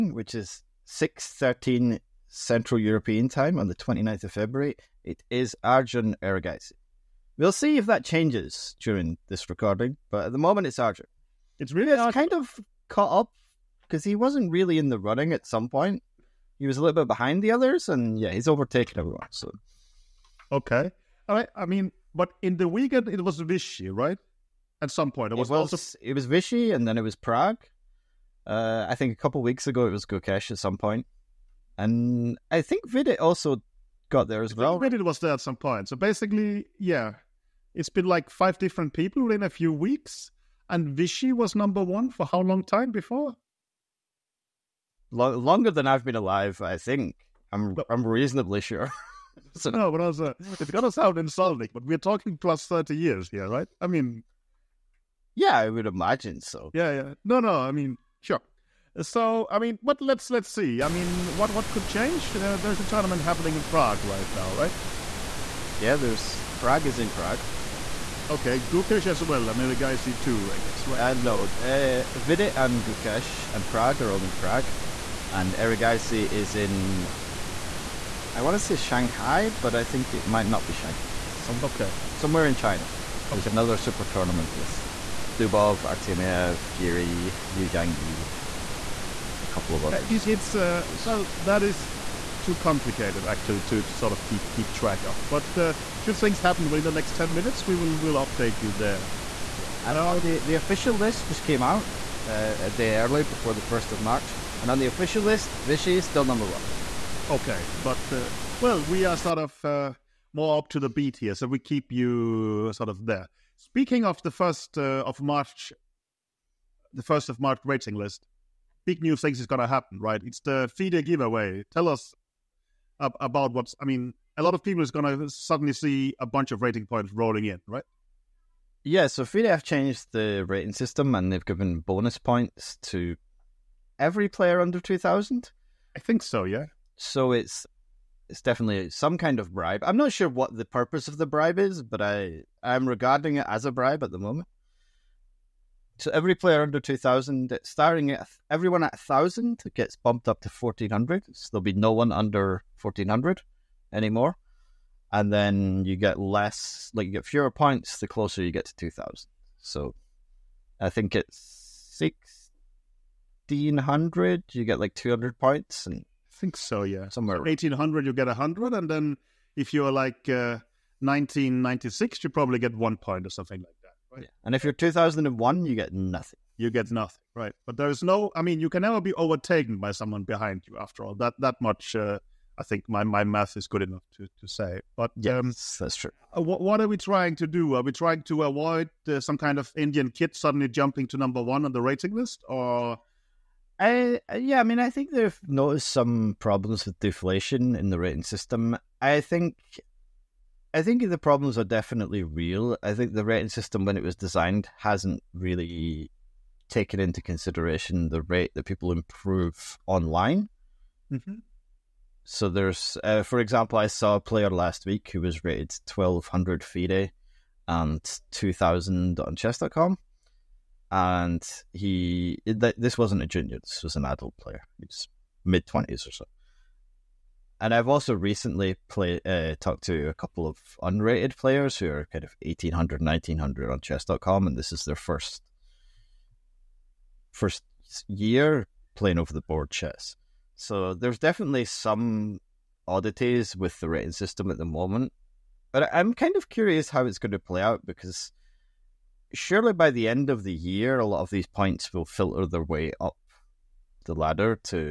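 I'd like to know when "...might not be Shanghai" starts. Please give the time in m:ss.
1:20.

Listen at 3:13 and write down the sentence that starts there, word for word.
I, uh, yeah, I mean, I think they've noticed some problems with deflation in the rating system.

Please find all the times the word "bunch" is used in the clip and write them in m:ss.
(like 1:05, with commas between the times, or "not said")
2:06.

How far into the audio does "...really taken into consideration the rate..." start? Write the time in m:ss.
3:25.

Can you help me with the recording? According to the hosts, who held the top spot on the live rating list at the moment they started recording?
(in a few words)
Arjun Erigaisi.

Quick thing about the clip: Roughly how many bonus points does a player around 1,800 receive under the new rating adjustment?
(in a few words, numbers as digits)
100.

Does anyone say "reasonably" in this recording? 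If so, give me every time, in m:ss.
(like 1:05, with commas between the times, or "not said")
0:48.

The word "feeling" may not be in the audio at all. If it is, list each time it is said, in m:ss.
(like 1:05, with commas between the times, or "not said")
not said.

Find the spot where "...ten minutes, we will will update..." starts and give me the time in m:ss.
1:37.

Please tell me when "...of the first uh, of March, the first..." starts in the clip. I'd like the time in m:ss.
1:54.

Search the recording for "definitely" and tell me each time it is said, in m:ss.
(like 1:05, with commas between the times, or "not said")
2:18, 3:21, 4:01.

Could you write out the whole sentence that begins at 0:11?
It's really it's kind of caught up because he wasn't really in the running at some point.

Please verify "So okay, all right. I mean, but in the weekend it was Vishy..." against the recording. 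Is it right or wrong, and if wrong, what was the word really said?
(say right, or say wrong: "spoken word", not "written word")
right.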